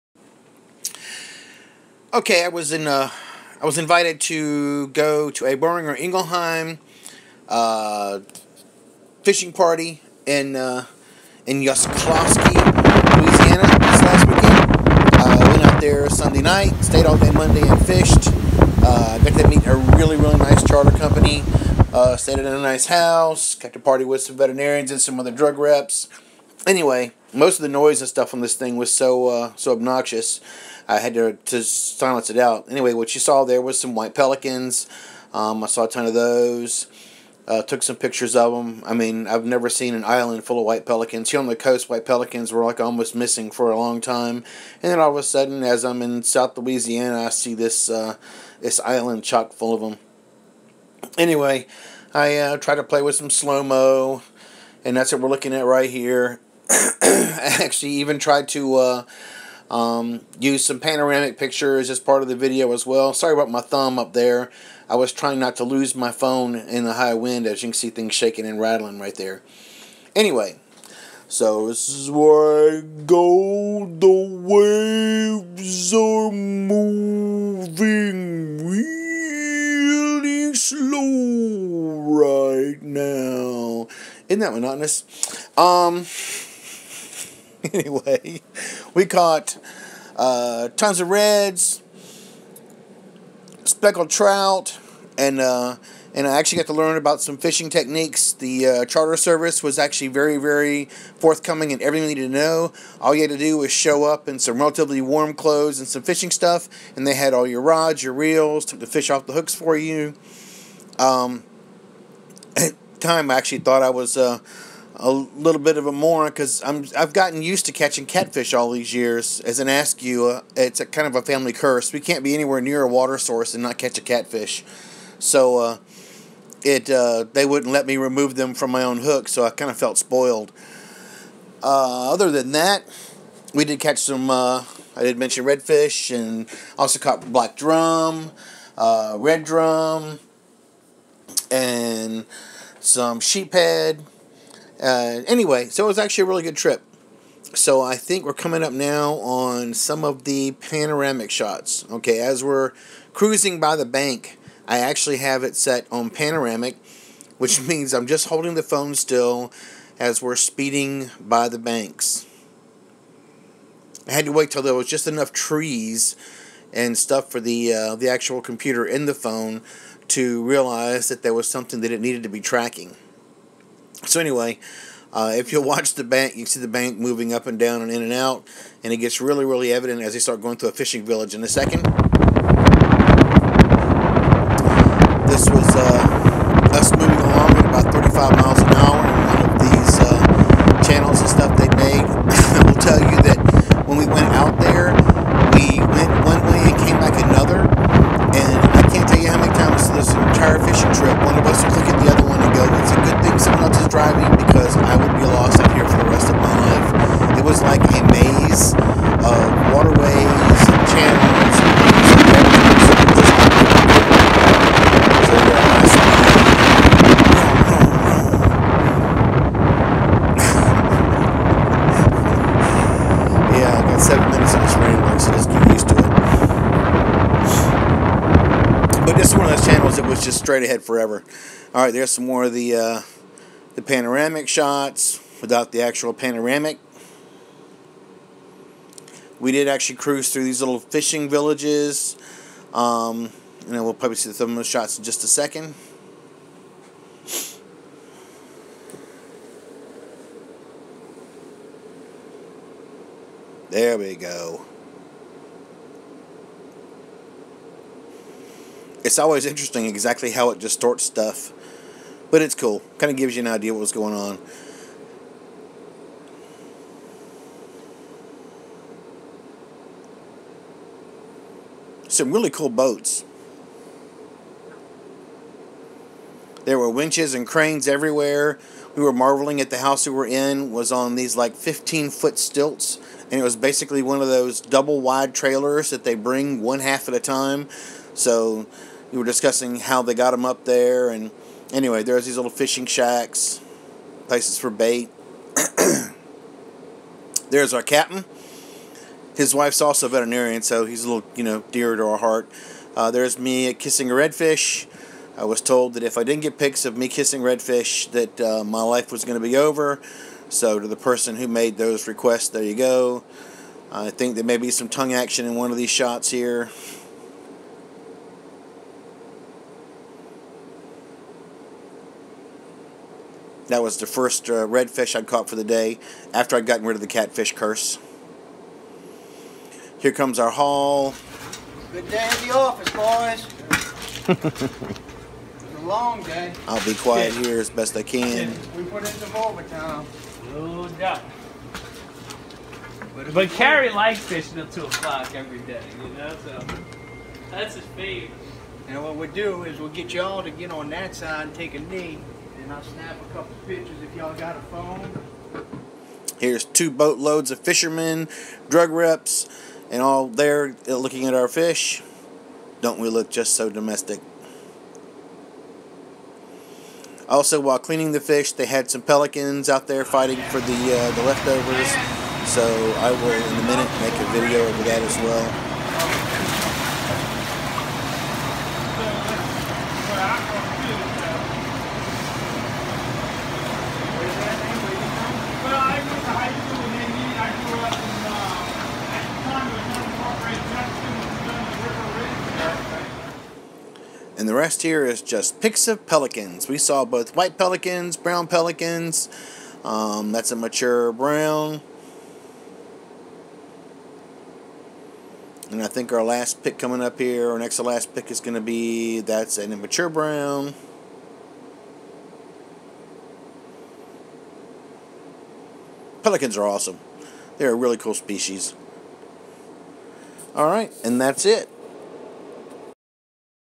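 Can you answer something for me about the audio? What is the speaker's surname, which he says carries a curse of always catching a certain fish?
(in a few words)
Askew.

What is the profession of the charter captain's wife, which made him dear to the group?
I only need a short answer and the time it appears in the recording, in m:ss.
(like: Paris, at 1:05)
veterinarian, at 5:00.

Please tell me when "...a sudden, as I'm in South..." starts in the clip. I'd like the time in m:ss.
0:45.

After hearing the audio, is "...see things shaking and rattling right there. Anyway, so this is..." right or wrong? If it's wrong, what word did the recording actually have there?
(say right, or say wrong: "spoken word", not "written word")
right.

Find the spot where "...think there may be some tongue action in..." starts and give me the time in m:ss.
5:14.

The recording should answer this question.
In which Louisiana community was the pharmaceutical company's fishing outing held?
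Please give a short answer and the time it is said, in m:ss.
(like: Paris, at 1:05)
Yscloskey, at 0:11.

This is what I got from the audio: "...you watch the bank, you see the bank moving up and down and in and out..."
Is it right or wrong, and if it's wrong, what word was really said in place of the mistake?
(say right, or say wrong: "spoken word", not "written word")
right.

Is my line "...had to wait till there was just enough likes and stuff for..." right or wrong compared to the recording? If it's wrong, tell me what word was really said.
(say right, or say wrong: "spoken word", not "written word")
wrong: "trees", not "likes".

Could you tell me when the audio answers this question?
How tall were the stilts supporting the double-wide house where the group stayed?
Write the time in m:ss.
4:41.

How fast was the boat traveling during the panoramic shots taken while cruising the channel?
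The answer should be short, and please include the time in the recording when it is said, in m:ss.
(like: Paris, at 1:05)
35 miles an hour, at 3:07.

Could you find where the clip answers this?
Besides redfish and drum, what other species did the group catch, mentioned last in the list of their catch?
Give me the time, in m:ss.
2:23.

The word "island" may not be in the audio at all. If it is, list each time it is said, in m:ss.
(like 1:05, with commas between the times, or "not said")
0:40, 0:48.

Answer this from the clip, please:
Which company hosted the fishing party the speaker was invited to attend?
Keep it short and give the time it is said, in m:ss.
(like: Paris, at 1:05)
Boehringer Ingelheim, at 0:05.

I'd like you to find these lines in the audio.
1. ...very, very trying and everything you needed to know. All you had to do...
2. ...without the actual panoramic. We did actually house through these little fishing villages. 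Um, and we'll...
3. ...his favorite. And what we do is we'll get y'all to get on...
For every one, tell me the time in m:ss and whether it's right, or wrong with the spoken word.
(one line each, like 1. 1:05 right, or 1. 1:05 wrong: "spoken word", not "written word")
1. 1:40 wrong: "forthcoming", not "trying"
2. 3:55 wrong: "cruise", not "house"
3. 5:47 right.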